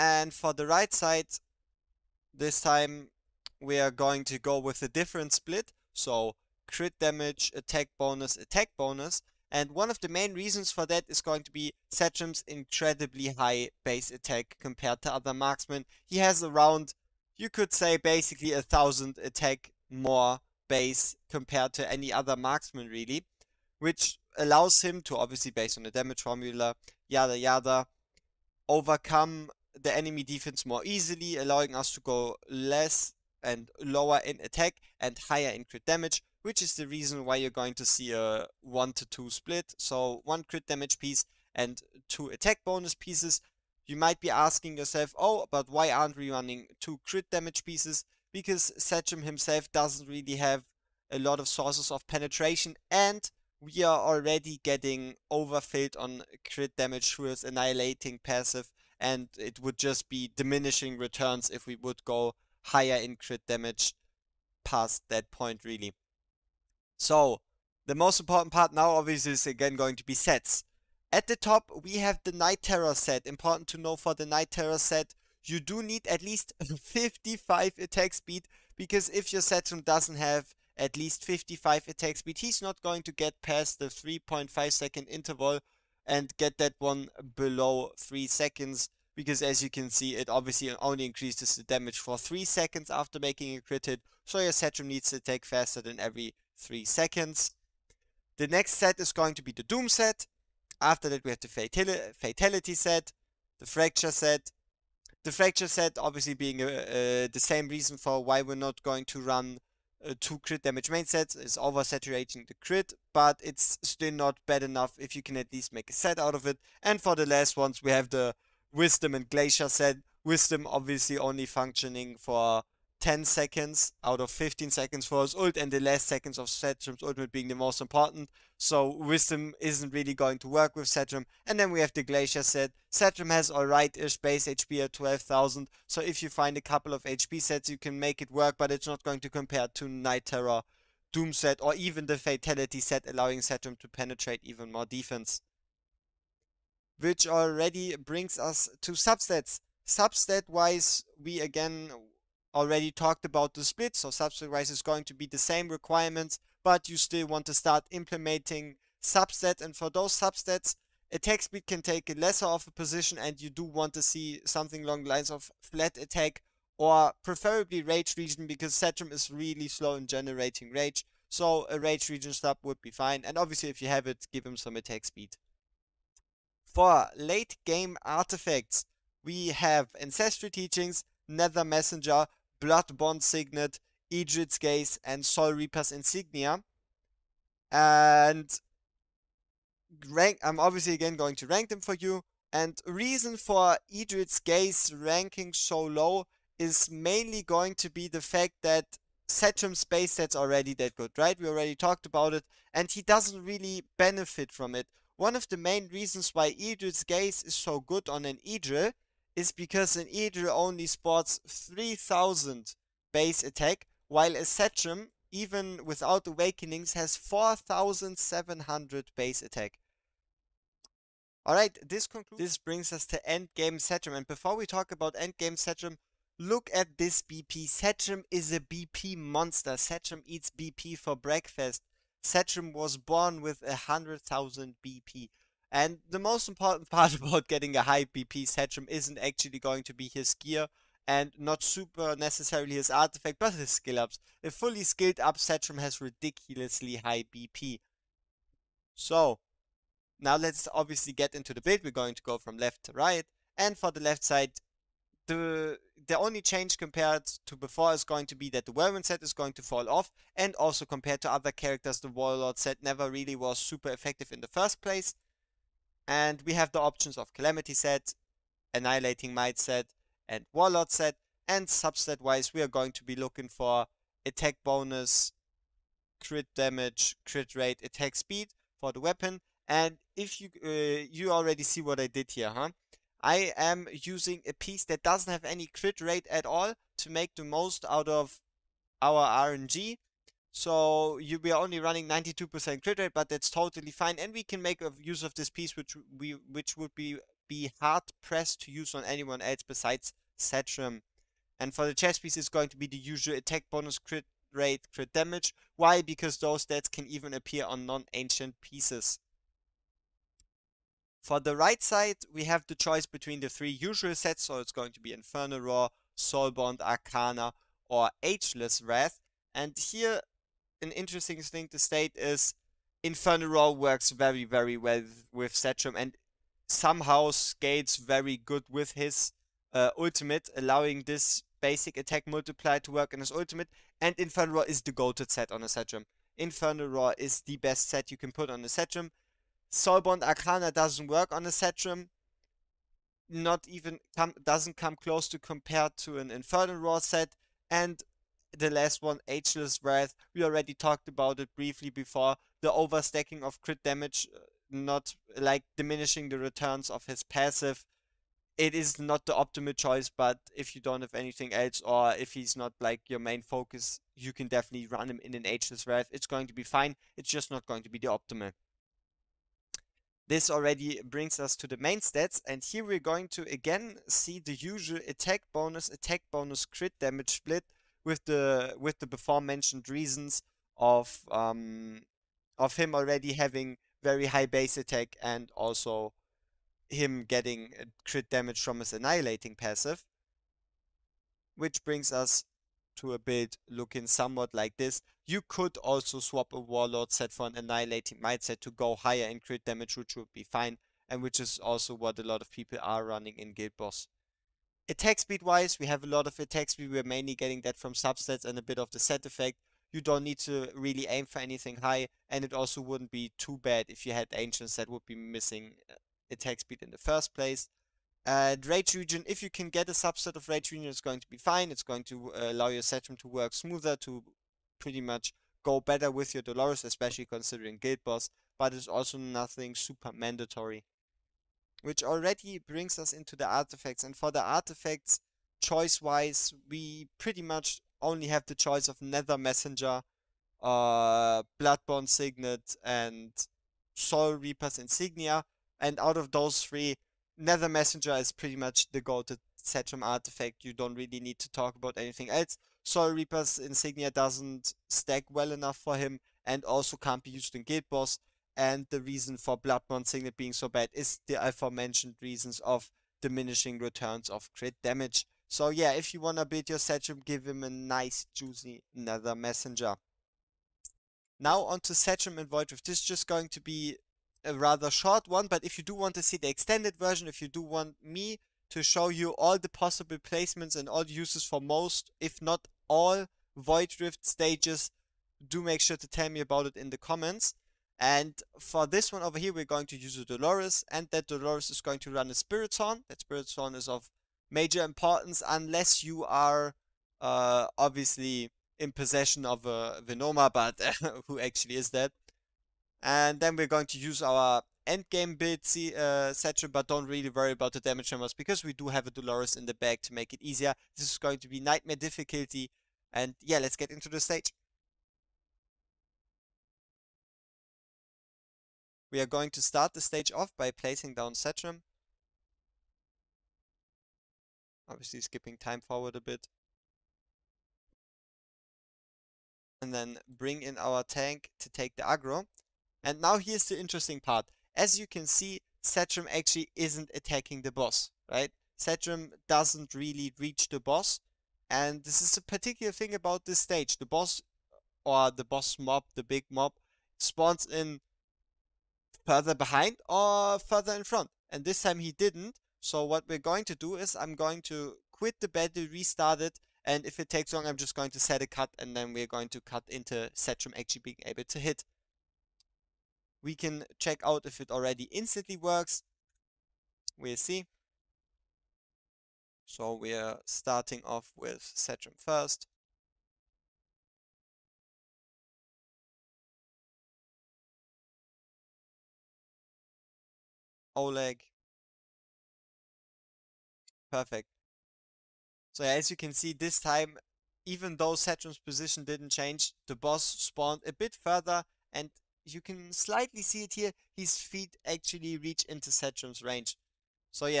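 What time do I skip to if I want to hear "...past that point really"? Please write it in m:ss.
1:04.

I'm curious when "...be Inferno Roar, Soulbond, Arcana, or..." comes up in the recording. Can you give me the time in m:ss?
5:14.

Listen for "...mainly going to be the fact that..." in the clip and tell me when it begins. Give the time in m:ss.
3:16.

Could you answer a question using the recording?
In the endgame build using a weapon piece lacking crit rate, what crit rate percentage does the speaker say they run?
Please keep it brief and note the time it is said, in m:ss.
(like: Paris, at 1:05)
92%, at 4:52.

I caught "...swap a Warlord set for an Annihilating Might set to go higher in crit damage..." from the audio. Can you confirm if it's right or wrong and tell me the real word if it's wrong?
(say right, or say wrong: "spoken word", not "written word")
right.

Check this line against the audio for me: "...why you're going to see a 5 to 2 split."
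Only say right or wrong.
wrong.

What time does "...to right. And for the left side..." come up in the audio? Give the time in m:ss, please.
4:12.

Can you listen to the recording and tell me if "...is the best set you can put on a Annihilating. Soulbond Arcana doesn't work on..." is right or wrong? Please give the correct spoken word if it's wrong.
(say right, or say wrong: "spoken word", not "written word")
wrong: "Setram", not "Annihilating".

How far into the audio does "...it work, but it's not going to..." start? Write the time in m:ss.
2:18.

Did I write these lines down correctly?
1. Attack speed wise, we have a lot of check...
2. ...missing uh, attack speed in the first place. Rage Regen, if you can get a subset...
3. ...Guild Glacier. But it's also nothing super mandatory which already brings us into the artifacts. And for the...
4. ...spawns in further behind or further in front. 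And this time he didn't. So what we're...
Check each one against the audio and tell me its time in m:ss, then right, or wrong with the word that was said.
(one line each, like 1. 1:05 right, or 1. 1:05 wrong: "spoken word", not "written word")
1. 6:44 wrong: "attack", not "check"
2. 6:55 right
3. 7:07 wrong: "Boss", not "Glacier"
4. 9:07 right.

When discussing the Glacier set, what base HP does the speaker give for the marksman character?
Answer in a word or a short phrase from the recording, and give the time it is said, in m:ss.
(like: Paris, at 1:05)
12,000, at 2:14.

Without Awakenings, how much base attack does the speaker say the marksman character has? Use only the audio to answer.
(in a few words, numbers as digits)
4700.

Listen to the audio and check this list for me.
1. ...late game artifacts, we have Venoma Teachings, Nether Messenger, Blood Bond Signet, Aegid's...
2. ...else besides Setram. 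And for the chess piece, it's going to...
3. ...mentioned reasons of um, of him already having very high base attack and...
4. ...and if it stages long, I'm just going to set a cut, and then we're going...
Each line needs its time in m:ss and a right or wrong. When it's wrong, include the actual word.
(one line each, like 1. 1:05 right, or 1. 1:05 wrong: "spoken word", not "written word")
1. 2:57 wrong: "Ancestry", not "Venoma"
2. 4:59 right
3. 6:19 right
4. 9:16 wrong: "takes", not "stages".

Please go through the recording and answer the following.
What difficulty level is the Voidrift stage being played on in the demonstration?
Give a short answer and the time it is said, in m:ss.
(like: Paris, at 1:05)
nightmare, at 8:31.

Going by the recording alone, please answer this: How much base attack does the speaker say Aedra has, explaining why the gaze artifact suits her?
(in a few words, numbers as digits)
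3000.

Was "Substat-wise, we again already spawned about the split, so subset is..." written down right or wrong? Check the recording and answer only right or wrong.
wrong.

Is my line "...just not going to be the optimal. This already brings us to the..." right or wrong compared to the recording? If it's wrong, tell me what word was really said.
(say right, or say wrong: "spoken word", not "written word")
right.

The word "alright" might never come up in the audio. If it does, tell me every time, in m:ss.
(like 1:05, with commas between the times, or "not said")
2:13, 3:41.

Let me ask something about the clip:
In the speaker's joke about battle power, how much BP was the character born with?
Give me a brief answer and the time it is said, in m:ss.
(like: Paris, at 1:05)
100,000, at 3:53.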